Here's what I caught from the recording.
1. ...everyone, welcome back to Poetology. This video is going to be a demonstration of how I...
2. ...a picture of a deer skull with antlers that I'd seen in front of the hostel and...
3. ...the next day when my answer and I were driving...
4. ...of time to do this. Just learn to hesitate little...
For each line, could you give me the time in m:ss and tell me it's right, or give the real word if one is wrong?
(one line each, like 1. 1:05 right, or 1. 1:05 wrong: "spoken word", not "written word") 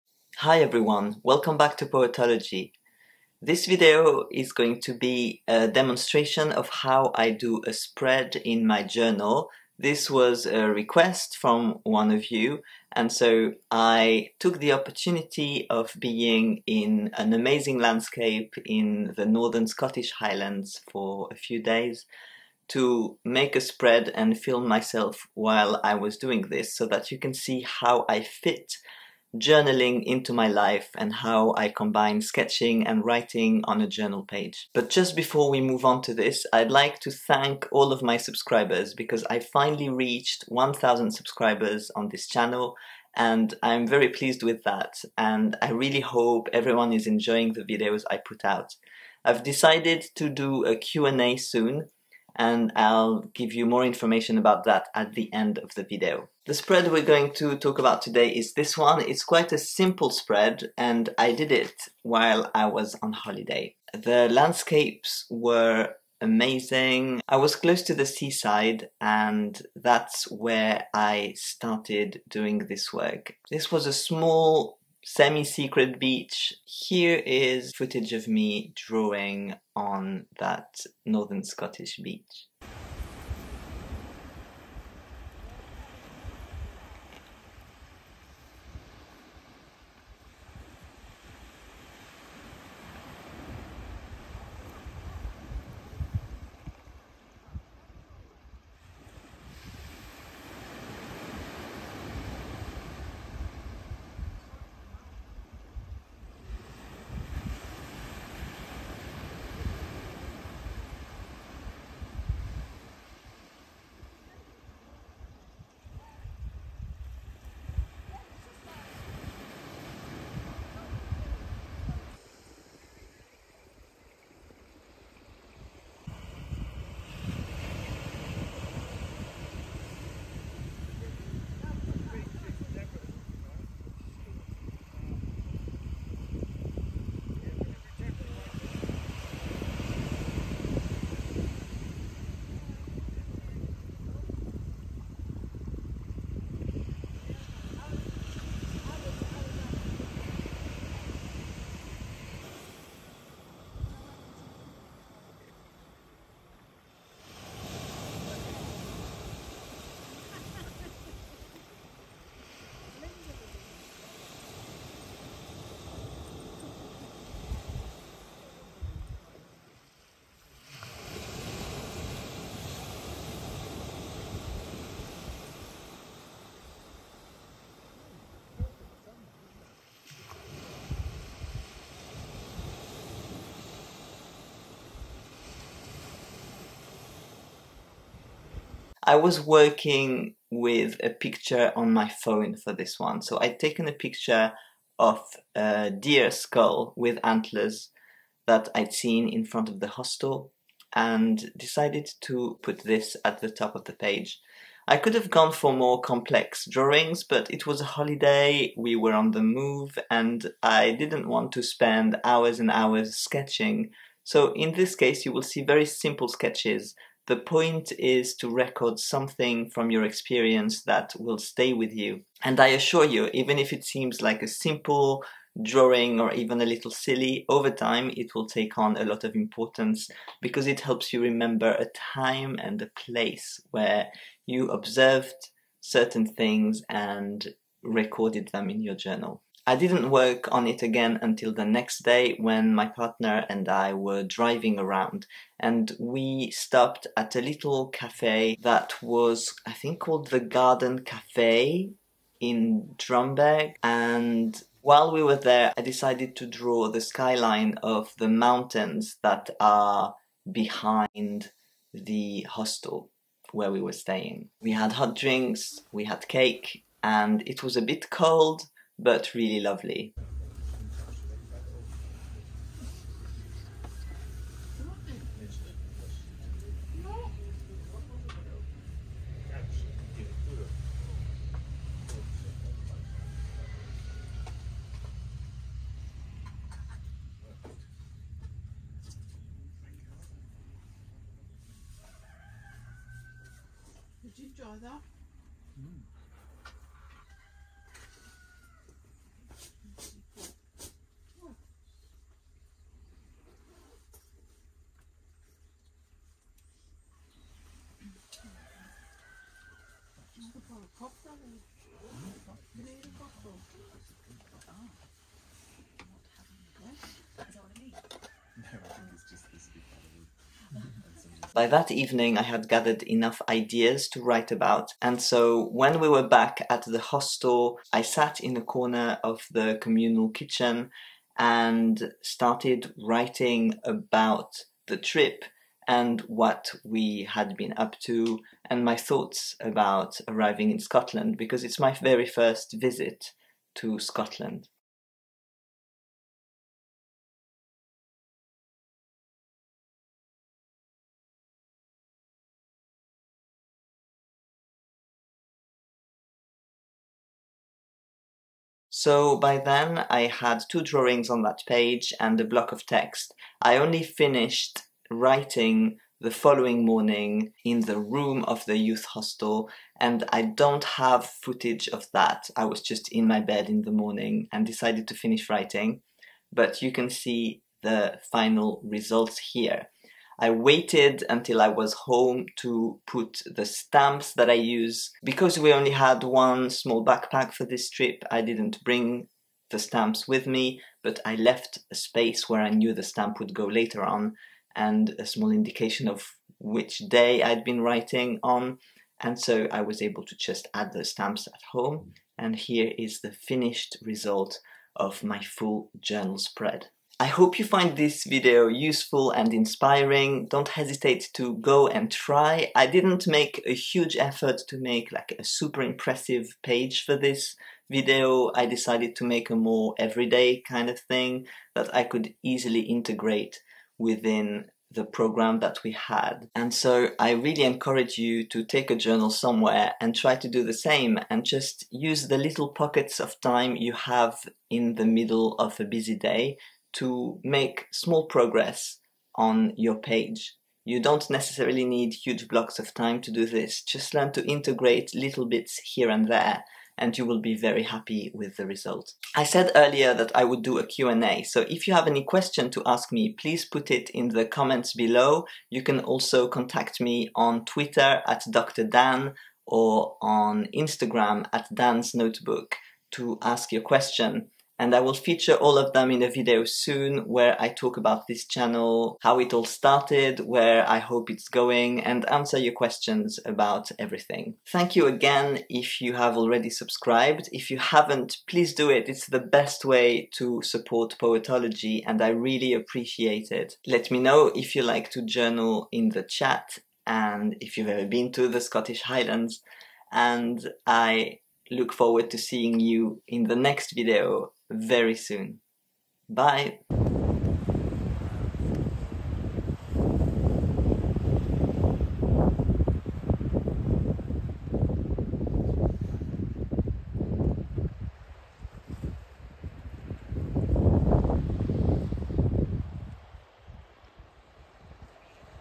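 1. 0:00 right
2. 3:13 right
3. 4:01 wrong: "partner", not "answer"
4. 7:22 wrong: "integrate", not "hesitate".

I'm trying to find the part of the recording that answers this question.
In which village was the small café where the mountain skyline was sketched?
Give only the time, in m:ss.
4:12.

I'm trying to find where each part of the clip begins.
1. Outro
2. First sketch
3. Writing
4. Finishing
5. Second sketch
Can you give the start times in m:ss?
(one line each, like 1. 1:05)
1. 6:47
2. 1:23
3. 5:27
4. 6:08
5. 4:07.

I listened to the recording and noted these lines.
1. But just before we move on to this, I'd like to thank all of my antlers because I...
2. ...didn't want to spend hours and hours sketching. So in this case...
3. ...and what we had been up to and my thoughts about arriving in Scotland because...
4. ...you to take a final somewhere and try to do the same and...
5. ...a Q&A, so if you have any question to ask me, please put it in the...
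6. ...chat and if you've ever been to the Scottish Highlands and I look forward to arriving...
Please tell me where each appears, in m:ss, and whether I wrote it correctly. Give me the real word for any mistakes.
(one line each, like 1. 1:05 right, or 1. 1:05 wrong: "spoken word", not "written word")
1. 0:34 wrong: "subscribers", not "antlers"
2. 3:30 right
3. 5:35 right
4. 7:08 wrong: "journal", not "final"
5. 7:30 right
6. 8:06 wrong: "seeing", not "arriving".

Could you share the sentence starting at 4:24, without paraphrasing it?
We had hot drinks, we had cake and it was a bit cold but really lovely.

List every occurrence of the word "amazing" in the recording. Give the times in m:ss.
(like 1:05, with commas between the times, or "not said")
0:17, 1:06.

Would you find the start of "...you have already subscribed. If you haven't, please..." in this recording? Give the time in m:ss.
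7:56.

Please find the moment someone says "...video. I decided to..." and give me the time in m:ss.
6:57.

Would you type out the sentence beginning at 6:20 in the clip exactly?
I waited until I was home to put the stamps that I use.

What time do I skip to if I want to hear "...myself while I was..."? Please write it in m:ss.
0:24.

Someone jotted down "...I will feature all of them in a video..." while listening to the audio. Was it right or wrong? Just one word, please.
right.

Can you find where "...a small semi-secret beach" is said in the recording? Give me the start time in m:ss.
1:13.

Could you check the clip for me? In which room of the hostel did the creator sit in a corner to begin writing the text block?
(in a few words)
Communal kitchen.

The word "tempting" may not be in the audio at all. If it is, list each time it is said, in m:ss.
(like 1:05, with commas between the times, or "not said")
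not said.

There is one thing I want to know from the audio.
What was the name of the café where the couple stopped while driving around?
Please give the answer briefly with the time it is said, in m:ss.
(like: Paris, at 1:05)
Garden Cafe, at 4:10.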